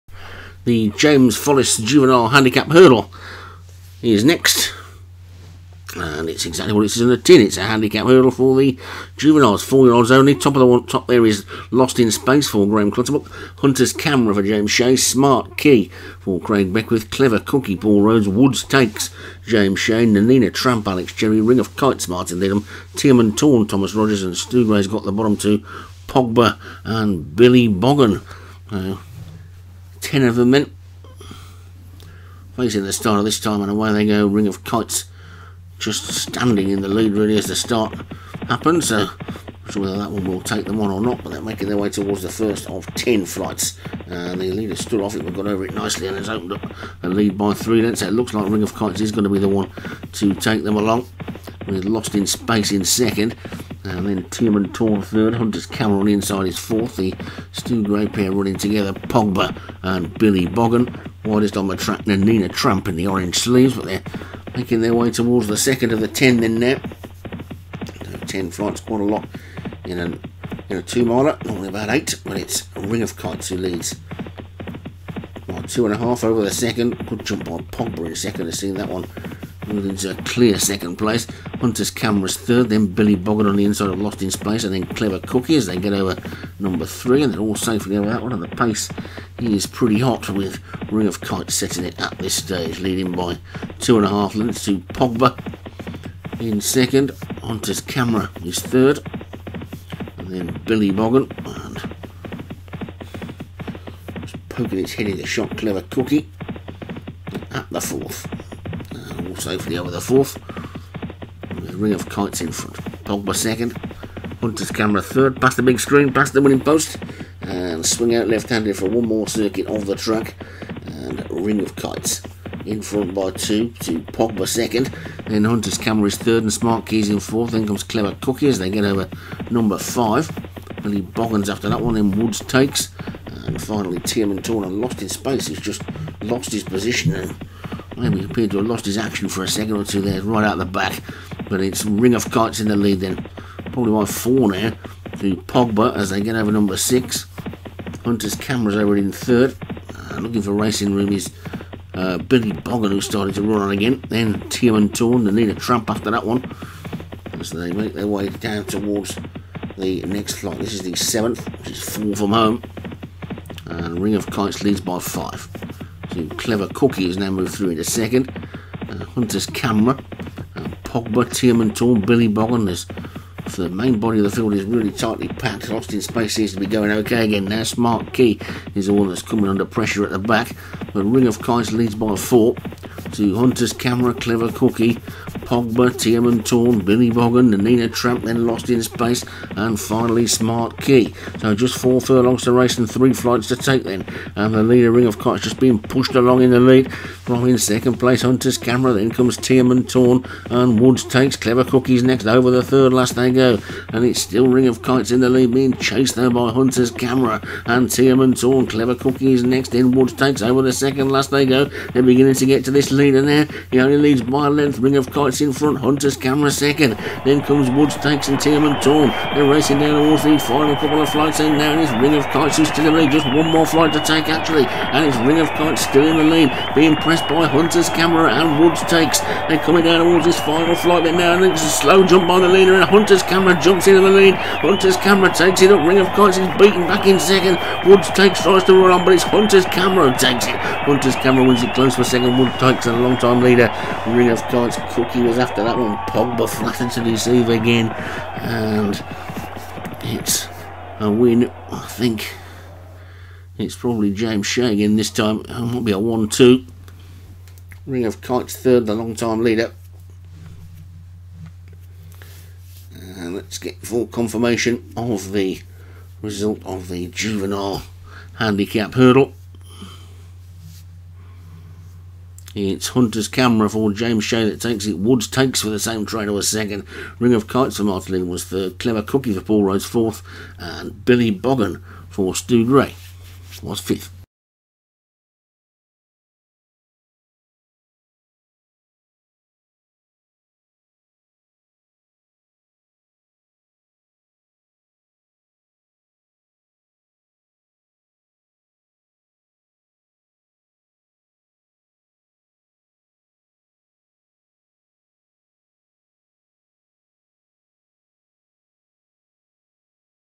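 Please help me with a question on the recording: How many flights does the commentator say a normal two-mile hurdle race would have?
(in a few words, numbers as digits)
8.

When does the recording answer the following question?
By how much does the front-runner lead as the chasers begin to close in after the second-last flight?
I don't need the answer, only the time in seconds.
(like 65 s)
213 s.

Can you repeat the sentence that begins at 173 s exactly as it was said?
the main body of the field is really tightly packed.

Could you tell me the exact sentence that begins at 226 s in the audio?
Being pressed by Hunter's camera and Woods takes.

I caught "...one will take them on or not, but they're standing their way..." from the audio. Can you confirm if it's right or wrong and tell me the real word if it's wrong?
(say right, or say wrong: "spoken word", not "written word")
wrong: "making", not "standing".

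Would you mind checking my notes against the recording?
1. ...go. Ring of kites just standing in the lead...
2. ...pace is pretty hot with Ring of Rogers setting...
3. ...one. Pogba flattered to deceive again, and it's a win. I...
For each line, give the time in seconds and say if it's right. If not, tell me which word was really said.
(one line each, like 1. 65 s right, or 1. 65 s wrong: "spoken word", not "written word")
1. 34 s right
2. 88 s wrong: "Kite", not "Rogers"
3. 245 s right.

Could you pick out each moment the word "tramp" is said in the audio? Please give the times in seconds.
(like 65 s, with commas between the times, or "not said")
20 s, 62 s, 155 s, 187 s.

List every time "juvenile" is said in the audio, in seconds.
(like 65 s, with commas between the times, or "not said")
1 s, 9 s, 267 s.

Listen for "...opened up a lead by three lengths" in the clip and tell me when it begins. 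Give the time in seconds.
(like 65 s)
46 s.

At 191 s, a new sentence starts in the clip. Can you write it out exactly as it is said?
So just four furlongs to race and three flights to take then.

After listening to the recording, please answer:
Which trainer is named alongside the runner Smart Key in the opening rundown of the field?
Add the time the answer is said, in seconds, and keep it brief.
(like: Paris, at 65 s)
Craig Beckwith, at 16 s.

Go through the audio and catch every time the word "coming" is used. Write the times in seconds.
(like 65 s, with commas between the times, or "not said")
179 s, 229 s.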